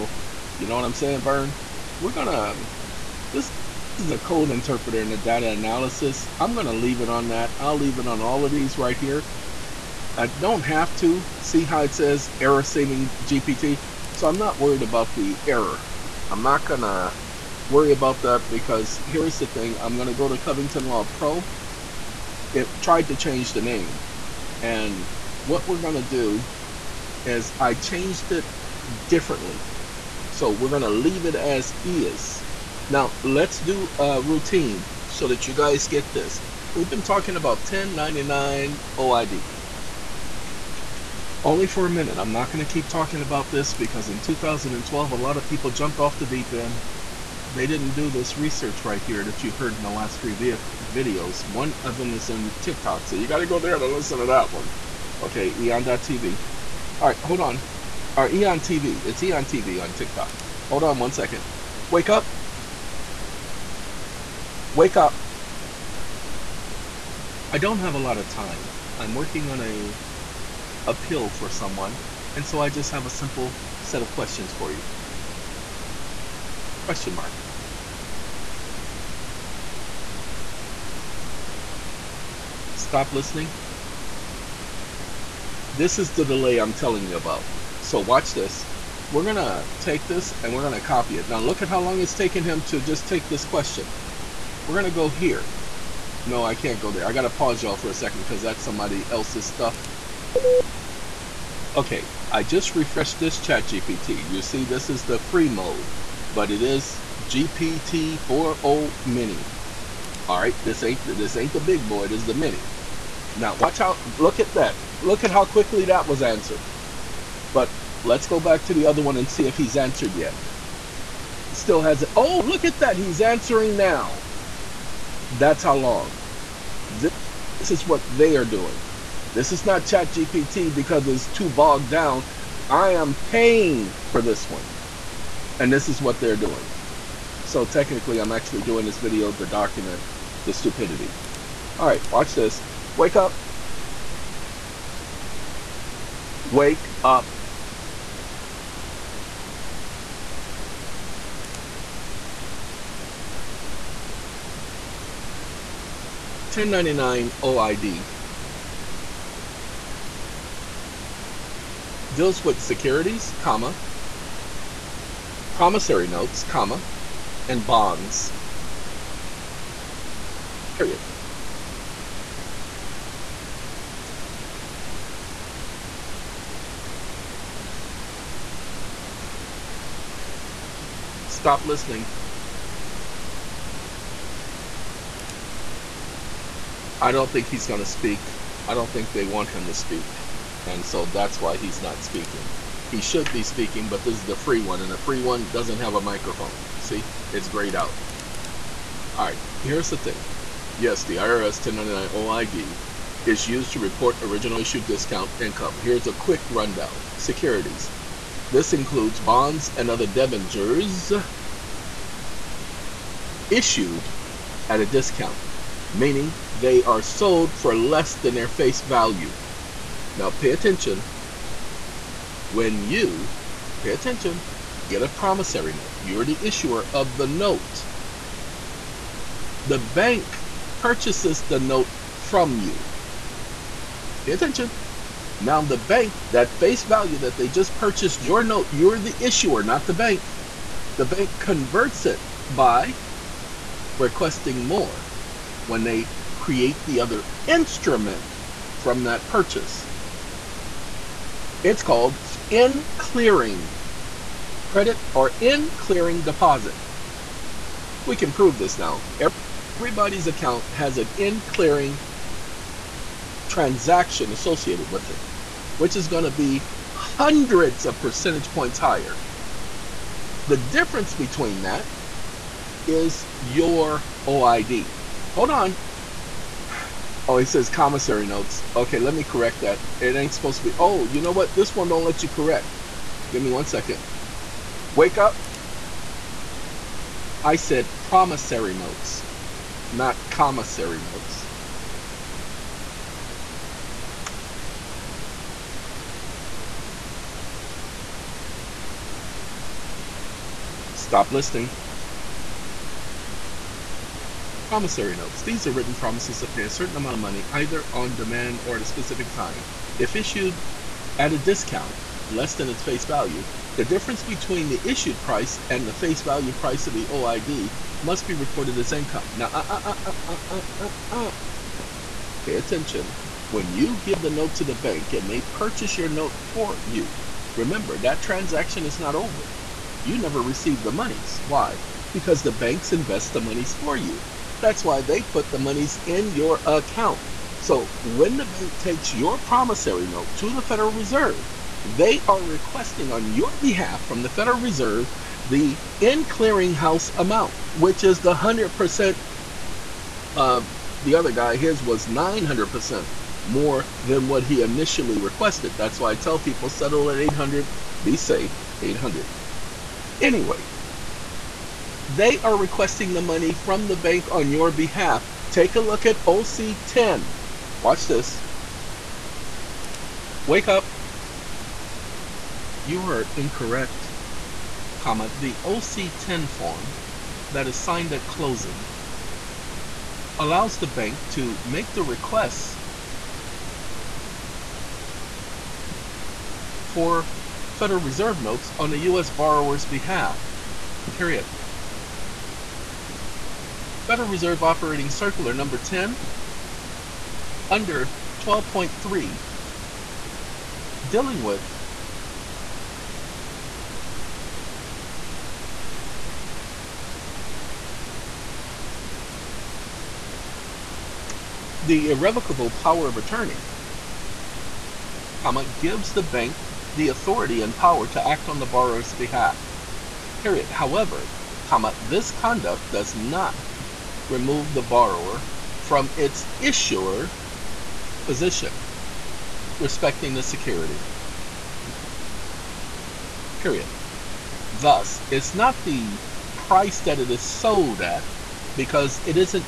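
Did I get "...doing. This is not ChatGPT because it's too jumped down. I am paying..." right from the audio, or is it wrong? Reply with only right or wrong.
wrong.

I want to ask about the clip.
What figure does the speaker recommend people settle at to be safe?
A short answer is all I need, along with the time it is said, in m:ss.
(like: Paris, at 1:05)
800, at 5:57.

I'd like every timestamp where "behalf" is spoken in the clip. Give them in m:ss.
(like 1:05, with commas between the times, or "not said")
5:43, 6:04, 6:29, 6:59.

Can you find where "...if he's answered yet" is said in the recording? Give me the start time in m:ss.
1:59.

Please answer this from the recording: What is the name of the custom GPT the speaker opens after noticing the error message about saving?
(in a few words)
Covington Law Pro.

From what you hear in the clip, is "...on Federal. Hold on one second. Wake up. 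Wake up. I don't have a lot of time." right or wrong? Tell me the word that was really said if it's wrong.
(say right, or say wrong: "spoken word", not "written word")
wrong: "TikTok", not "Federal".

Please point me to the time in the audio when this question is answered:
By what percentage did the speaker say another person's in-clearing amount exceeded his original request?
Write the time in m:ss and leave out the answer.
5:52.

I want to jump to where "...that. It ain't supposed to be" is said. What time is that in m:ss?
4:39.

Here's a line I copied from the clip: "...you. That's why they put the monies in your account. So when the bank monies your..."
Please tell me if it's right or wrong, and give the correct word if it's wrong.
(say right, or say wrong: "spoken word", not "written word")
wrong: "takes", not "monies".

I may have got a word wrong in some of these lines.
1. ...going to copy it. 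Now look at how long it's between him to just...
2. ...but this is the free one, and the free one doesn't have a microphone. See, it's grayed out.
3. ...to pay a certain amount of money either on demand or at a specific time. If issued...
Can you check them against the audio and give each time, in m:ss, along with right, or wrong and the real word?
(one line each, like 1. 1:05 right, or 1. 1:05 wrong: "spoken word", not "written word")
1. 1:30 wrong: "taken", not "between"
2. 3:13 right
3. 5:06 right.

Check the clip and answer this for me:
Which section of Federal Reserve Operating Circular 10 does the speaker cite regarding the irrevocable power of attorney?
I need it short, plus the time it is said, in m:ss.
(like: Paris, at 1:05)
12.3, at 6:38.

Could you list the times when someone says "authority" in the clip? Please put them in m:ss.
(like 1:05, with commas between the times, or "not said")
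6:57.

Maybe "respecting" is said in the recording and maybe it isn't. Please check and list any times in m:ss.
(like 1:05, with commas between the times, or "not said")
7:09.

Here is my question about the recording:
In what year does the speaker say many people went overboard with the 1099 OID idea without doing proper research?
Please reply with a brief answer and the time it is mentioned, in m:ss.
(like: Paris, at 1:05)
2012, at 0:44.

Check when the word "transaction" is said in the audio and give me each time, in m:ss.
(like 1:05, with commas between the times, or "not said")
4:23, 5:28.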